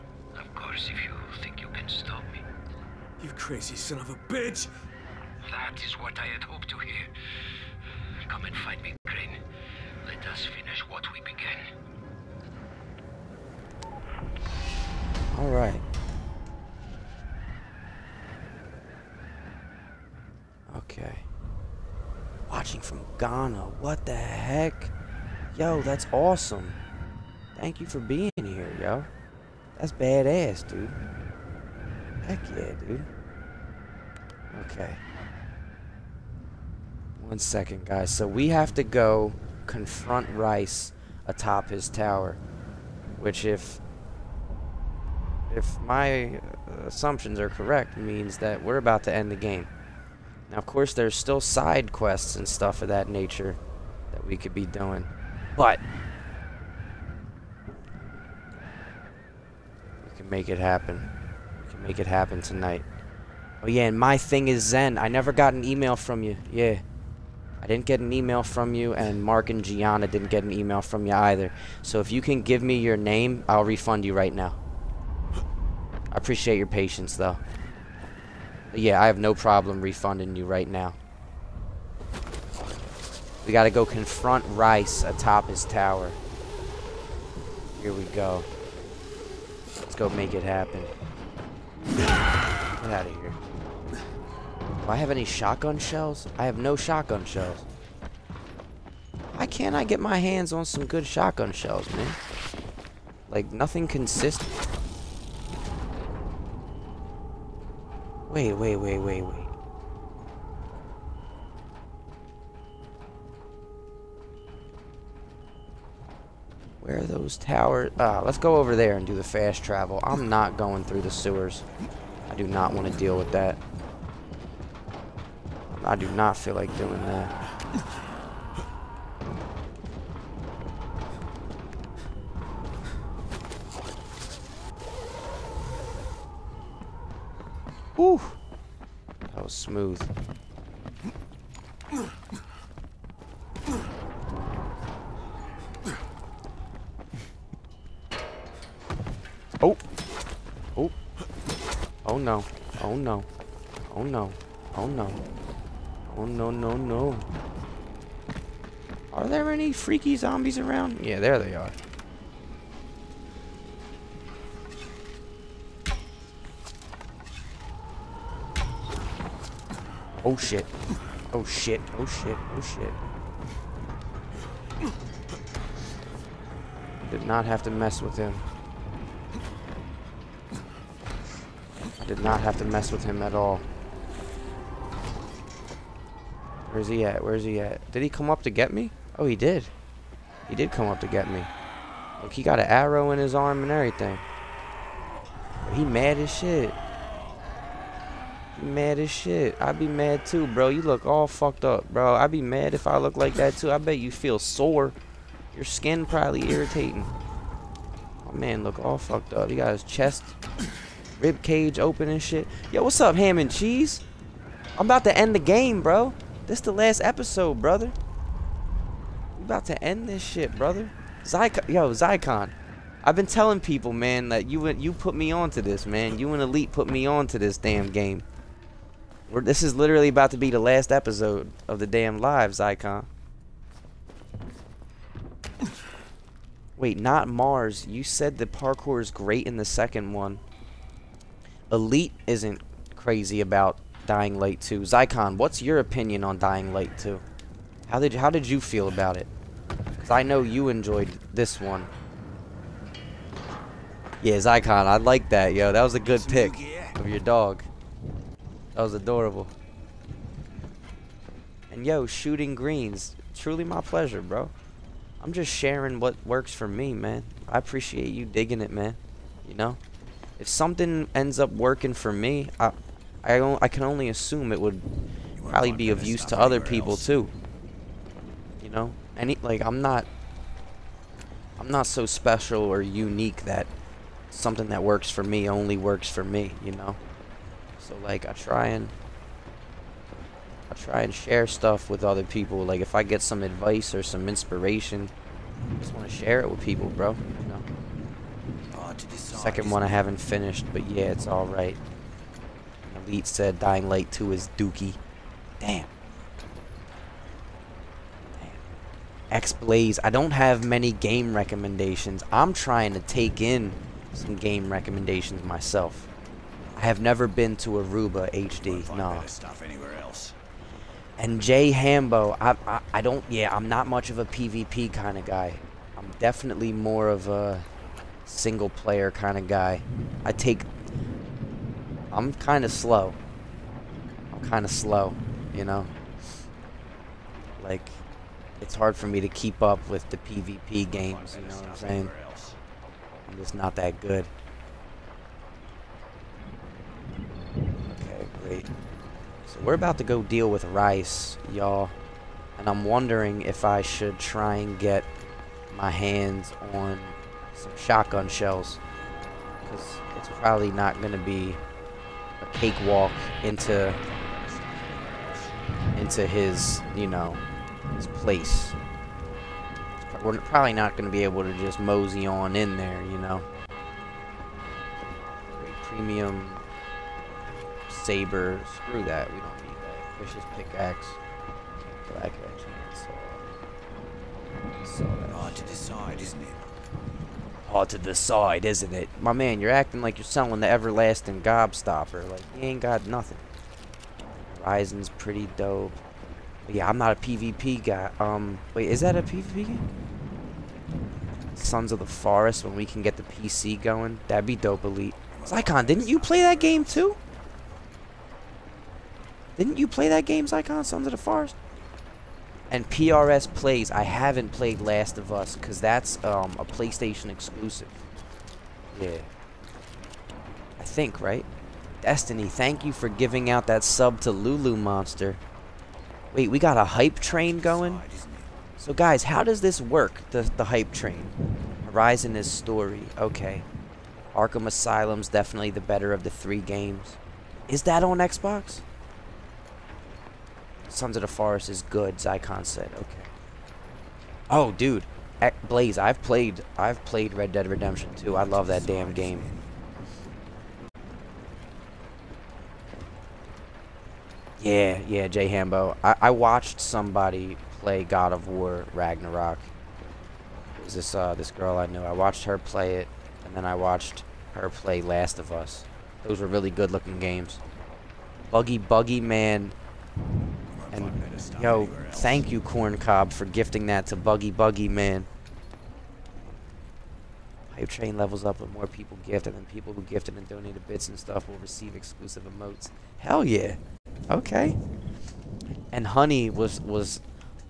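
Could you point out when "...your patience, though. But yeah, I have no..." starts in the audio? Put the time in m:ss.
1:16.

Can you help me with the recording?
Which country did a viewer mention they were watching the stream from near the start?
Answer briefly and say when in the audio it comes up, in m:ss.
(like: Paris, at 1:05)
Ghana, at 0:23.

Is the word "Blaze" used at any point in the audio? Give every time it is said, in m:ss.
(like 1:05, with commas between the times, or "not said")
5:09, 7:25.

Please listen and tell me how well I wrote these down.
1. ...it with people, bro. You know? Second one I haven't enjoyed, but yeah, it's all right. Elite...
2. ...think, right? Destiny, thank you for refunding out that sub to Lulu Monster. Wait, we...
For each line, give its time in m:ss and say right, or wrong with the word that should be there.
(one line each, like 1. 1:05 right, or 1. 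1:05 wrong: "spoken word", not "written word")
1. 4:56 wrong: "finished", not "enjoyed"
2. 7:00 wrong: "giving", not "refunding".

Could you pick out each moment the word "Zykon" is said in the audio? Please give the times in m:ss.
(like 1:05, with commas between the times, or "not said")
6:45, 7:22.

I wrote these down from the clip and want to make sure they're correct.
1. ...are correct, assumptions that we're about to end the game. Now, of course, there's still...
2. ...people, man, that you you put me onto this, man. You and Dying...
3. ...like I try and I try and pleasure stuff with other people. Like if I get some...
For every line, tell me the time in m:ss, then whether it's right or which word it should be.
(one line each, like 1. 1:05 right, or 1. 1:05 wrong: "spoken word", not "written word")
1. 0:47 wrong: "means", not "assumptions"
2. 3:43 wrong: "Elite", not "Dying"
3. 4:48 wrong: "share", not "pleasure".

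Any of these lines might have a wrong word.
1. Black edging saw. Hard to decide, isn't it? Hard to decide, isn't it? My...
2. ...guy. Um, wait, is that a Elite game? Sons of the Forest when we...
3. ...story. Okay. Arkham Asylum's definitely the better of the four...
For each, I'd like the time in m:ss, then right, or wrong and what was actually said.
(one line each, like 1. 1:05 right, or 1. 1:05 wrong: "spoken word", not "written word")
1. 6:22 right
2. 6:37 wrong: "PvP", not "Elite"
3. 7:12 wrong: "three", not "four".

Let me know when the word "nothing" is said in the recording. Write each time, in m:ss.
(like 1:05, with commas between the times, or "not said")
1:43, 6:33.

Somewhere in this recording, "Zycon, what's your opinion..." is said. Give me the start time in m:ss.
4:04.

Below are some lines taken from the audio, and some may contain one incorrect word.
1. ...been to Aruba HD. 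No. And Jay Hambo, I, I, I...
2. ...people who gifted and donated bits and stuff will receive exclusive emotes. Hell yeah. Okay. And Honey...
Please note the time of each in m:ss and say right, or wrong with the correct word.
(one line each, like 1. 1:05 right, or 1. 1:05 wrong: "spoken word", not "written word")
1. 5:17 right
2. 7:59 right.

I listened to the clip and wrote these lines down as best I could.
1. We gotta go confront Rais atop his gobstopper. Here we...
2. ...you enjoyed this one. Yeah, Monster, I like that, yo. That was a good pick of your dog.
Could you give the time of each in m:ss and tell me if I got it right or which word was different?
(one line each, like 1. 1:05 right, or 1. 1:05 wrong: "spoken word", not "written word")
1. 1:23 wrong: "tower", not "gobstopper"
2. 4:10 wrong: "Zycon", not "Monster".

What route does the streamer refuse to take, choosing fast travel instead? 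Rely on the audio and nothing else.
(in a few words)
The sewers.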